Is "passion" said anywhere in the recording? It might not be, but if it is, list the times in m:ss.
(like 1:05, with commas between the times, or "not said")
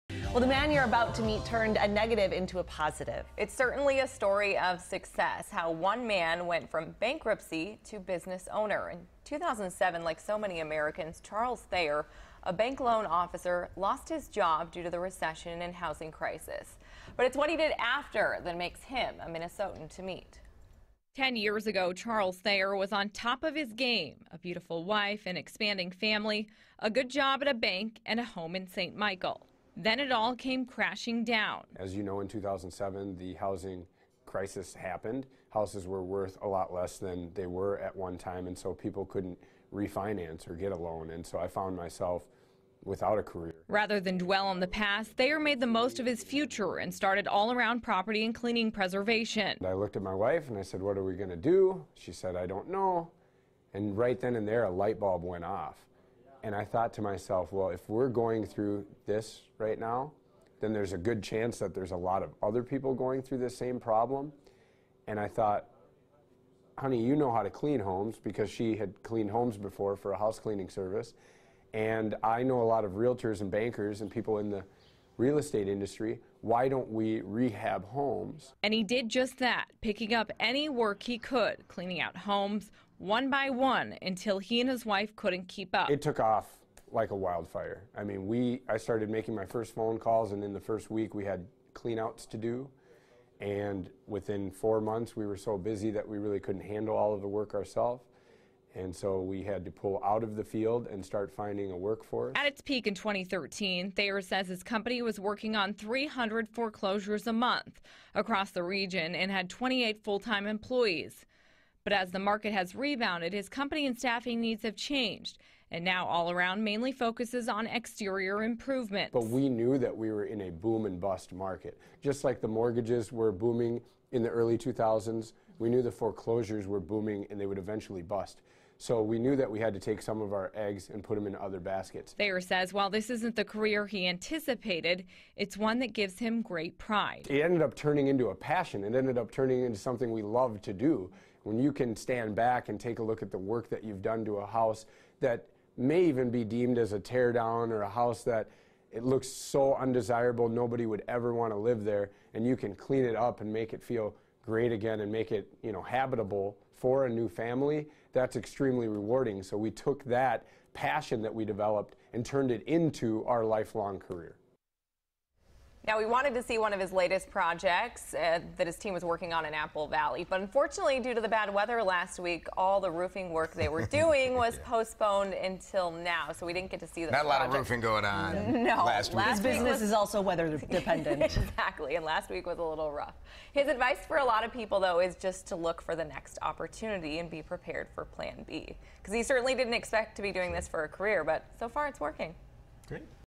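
2:18, 2:40.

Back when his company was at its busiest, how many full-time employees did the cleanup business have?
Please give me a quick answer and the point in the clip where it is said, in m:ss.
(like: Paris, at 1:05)
28, at 1:49.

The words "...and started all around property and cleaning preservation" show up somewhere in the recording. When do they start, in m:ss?
0:46.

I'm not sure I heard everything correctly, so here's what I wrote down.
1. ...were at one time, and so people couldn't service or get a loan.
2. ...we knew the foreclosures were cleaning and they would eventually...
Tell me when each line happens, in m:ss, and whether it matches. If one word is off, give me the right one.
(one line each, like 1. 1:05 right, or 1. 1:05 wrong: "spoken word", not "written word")
1. 0:37 wrong: "refinance", not "service"
2. 2:05 wrong: "booming", not "cleaning".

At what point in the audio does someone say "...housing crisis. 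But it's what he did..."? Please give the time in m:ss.
0:15.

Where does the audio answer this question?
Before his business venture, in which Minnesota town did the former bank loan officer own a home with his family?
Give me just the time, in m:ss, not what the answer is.
0:28.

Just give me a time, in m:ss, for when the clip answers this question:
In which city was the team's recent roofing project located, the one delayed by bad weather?
2:49.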